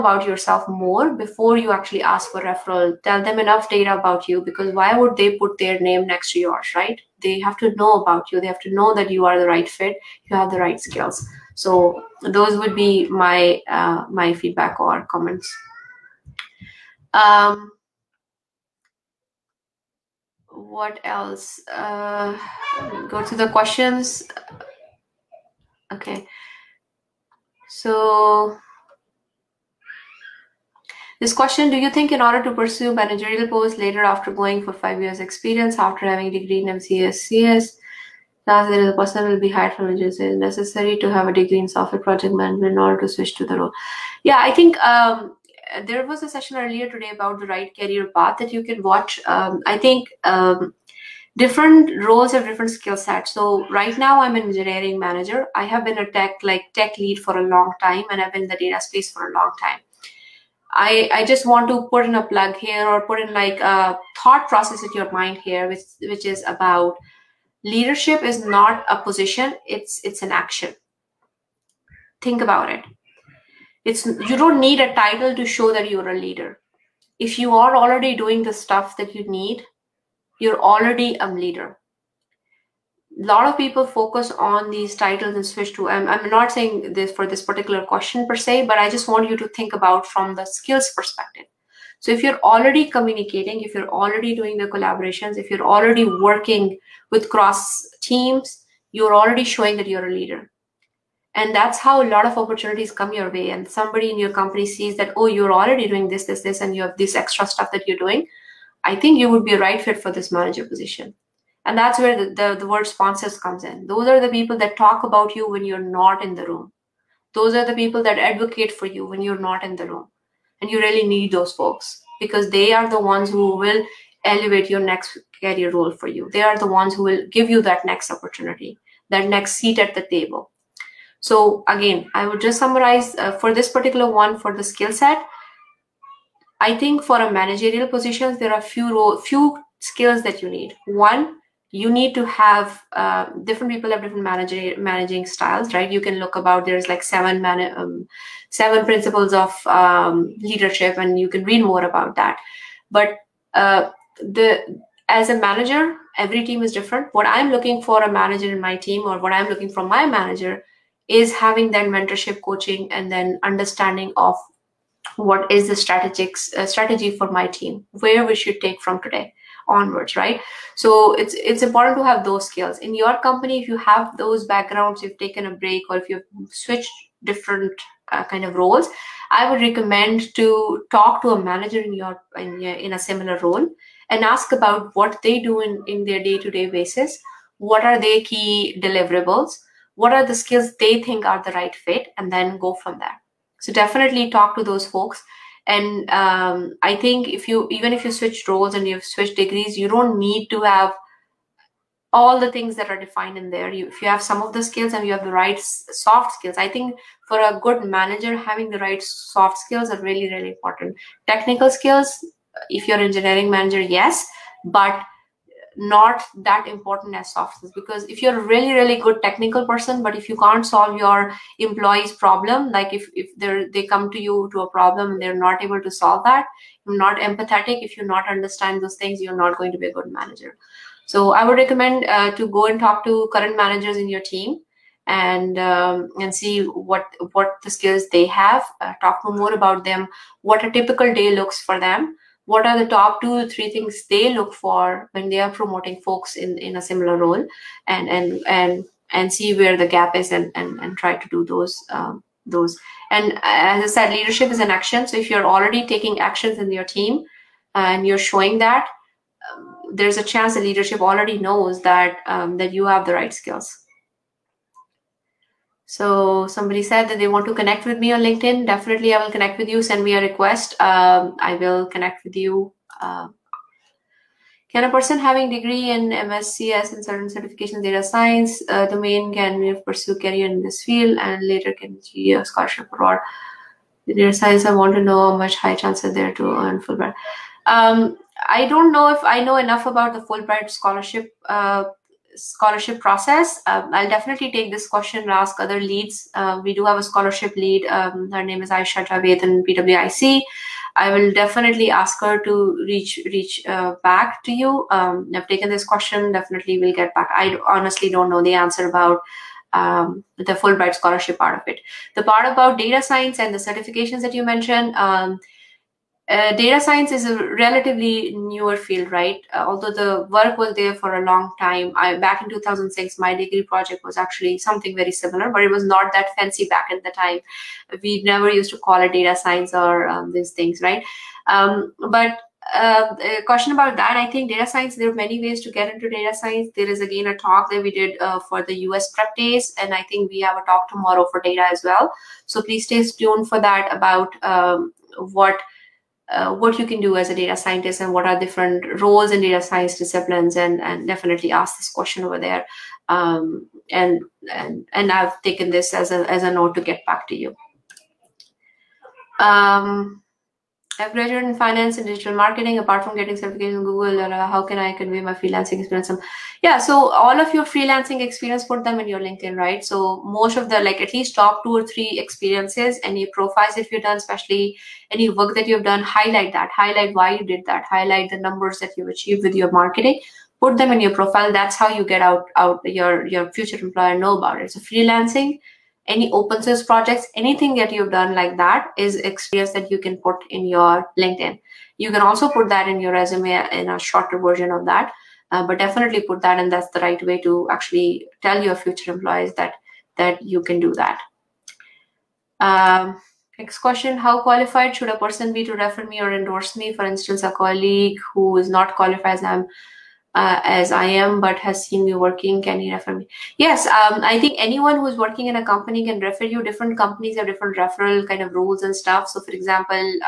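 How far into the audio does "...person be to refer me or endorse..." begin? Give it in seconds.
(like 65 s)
405 s.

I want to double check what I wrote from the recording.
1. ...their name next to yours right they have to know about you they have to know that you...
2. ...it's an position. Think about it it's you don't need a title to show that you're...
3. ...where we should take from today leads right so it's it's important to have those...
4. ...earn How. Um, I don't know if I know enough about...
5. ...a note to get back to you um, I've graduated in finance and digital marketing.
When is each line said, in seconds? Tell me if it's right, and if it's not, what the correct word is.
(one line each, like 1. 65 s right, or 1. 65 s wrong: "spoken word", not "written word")
1. 5 s right
2. 70 s wrong: "action", not "position"
3. 167 s wrong: "onwards", not "leads"
4. 286 s wrong: "Fulbright", not "How"
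5. 356 s right.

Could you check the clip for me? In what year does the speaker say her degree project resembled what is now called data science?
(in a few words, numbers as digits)
2006.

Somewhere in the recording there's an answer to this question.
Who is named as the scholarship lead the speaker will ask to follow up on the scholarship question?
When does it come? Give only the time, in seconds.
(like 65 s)
298 s.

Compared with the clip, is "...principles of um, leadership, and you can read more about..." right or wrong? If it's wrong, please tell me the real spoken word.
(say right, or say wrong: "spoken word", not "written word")
right.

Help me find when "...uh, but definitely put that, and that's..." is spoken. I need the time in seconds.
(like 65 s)
395 s.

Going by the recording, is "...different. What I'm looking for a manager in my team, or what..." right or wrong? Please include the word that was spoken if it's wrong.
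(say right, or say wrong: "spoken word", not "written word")
right.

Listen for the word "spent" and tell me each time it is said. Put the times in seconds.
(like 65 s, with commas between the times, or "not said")
not said.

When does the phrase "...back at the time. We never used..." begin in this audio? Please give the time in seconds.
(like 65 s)
326 s.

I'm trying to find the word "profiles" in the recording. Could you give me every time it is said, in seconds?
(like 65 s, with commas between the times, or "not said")
373 s, 381 s.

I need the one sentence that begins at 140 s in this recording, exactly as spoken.
One, you need to have uh, different people have different manager, managing styles, right?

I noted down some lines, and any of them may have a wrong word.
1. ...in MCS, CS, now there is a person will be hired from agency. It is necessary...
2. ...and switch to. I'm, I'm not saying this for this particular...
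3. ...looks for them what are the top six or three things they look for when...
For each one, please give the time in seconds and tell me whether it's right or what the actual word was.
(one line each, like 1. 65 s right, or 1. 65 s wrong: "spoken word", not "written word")
1. 36 s right
2. 85 s right
3. 241 s wrong: "two", not "six".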